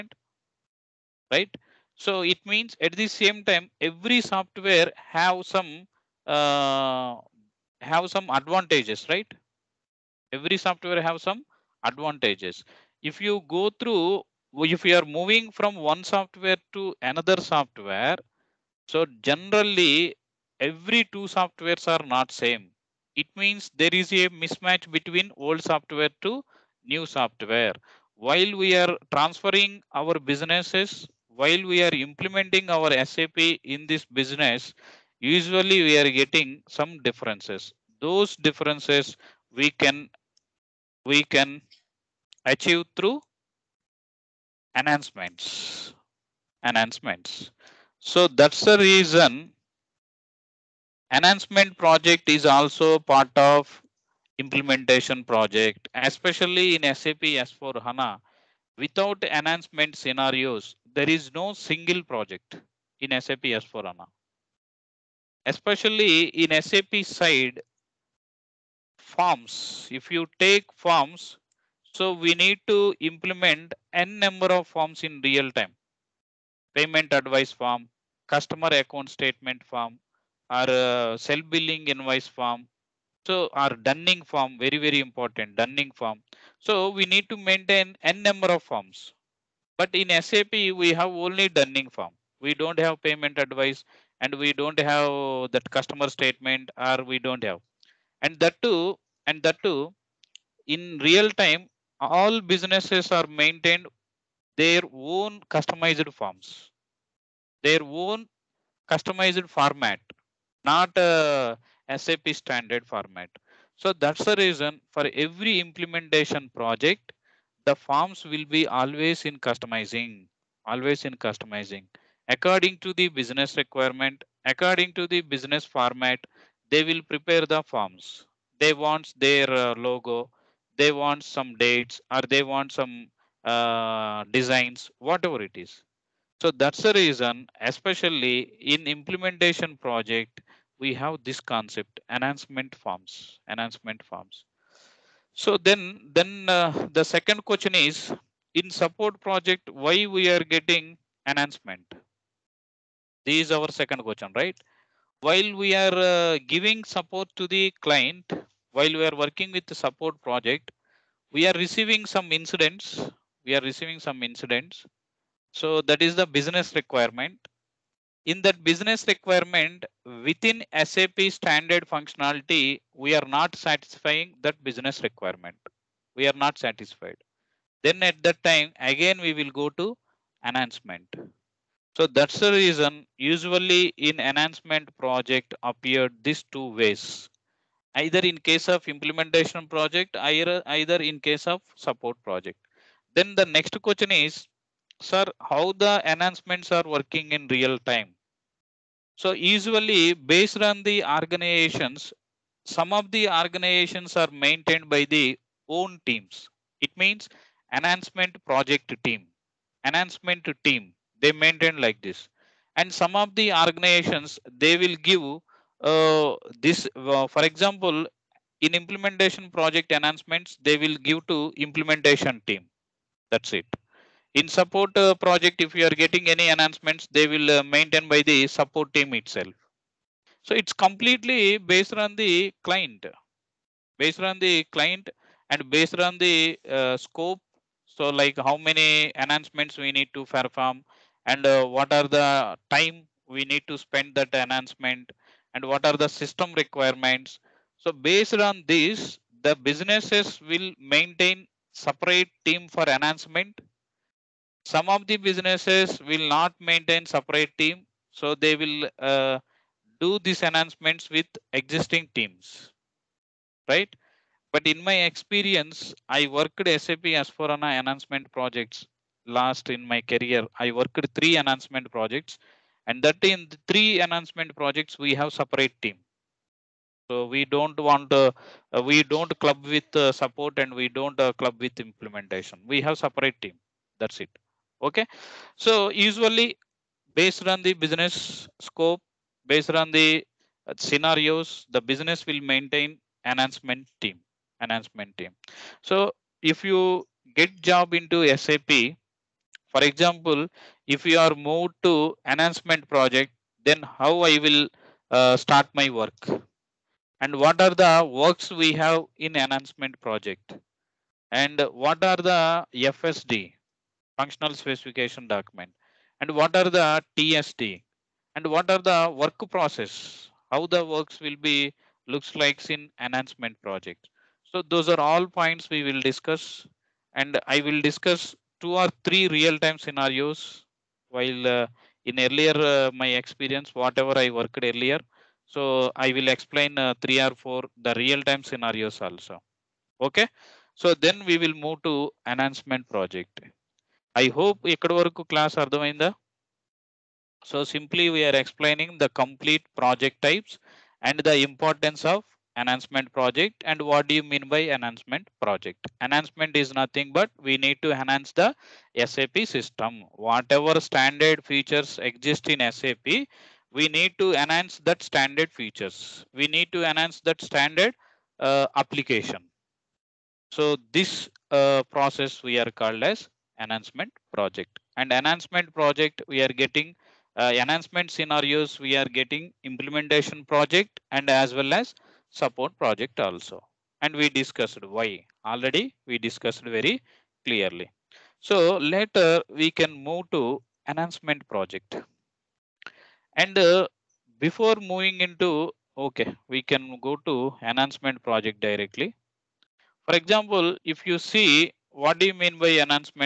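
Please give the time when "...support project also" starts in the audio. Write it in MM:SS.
06:22.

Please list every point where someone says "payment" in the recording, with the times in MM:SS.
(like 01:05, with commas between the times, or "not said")
01:16, 01:33.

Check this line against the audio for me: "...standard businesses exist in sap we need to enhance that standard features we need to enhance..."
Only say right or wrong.
wrong.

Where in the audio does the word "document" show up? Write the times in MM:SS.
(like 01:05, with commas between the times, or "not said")
05:15.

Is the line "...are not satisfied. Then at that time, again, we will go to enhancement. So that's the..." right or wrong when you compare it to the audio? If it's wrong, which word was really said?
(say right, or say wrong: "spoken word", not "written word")
right.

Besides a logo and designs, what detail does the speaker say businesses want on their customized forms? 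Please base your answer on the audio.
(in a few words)
Dates.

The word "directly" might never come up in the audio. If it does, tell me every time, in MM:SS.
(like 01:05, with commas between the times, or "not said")
06:38.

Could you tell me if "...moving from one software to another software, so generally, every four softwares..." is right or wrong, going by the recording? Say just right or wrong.
wrong.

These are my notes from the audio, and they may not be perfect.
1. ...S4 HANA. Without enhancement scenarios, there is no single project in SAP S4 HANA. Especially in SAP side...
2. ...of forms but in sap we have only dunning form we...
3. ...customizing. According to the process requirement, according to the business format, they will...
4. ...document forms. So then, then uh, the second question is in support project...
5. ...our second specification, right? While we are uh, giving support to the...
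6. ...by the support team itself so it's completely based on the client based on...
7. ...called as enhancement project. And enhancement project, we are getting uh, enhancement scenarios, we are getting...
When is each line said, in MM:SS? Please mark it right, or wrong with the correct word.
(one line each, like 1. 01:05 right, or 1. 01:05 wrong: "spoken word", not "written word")
1. 00:57 right
2. 01:28 right
3. 02:01 wrong: "business", not "process"
4. 02:23 wrong: "enhancement", not "document"
5. 02:33 wrong: "question", not "specification"
6. 03:48 right
7. 06:12 right.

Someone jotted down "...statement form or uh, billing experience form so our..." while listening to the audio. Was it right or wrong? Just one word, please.
wrong.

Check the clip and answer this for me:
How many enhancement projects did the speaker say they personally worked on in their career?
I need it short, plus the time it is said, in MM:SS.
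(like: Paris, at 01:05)
3, at 04:30.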